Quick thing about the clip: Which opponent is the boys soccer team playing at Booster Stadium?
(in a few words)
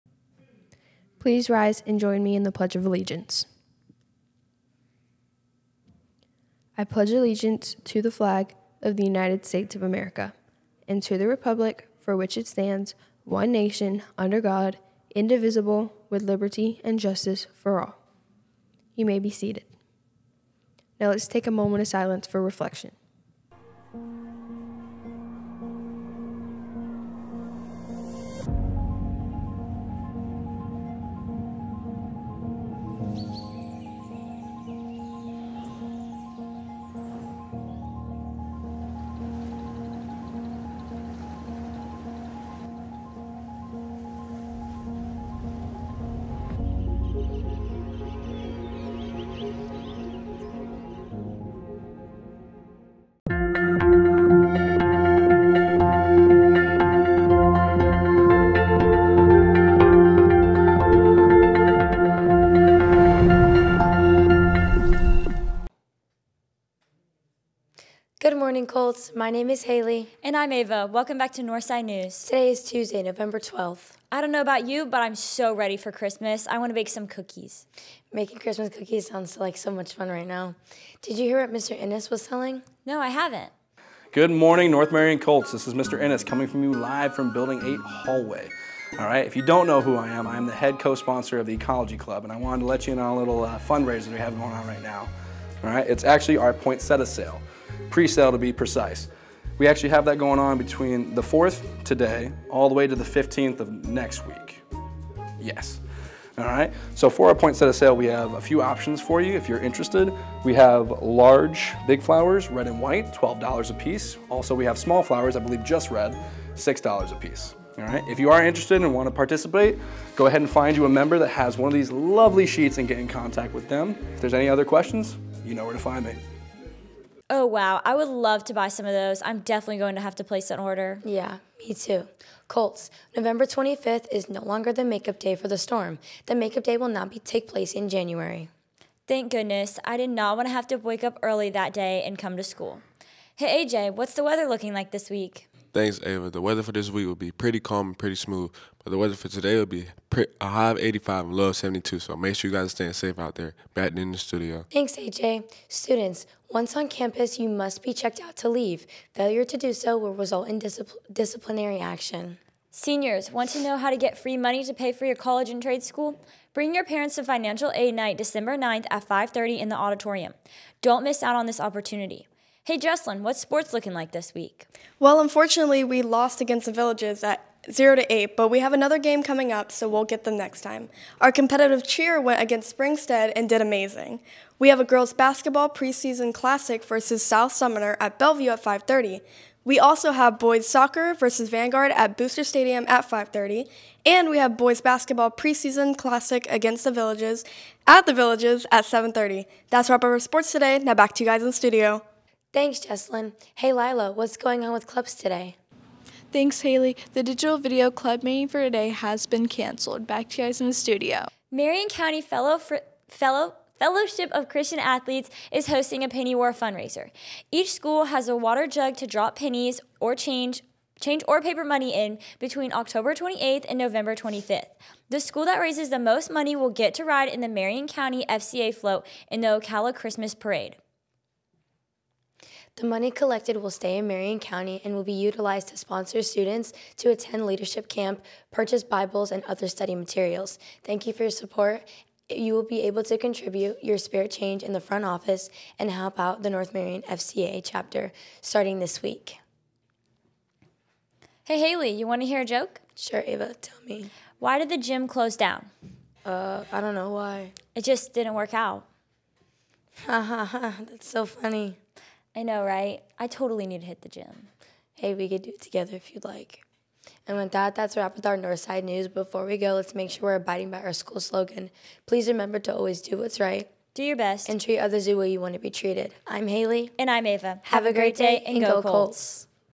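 Vanguard.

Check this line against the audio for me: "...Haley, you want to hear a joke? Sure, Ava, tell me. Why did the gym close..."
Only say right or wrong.
right.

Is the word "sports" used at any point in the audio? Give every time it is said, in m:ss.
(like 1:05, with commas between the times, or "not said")
2:53, 3:20.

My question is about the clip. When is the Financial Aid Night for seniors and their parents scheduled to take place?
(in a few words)
December 9th.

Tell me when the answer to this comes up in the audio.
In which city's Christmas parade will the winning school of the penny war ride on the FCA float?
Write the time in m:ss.
3:49.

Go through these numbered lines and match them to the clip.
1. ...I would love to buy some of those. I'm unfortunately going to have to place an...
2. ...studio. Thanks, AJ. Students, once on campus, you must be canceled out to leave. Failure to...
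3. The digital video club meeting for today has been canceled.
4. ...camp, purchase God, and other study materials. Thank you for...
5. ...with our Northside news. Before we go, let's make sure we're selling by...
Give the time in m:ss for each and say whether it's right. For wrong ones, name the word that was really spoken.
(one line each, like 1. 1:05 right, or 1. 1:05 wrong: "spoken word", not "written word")
1. 2:07 wrong: "definitely", not "unfortunately"
2. 2:34 wrong: "checked", not "canceled"
3. 3:27 right
4. 3:57 wrong: "Bibles", not "God"
5. 4:28 wrong: "abiding", not "selling".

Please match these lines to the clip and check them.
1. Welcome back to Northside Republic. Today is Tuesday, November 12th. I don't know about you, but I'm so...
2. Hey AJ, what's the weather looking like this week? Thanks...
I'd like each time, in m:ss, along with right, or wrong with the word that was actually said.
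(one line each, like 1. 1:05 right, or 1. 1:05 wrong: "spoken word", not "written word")
1. 1:10 wrong: "News", not "Republic"
2. 2:23 right.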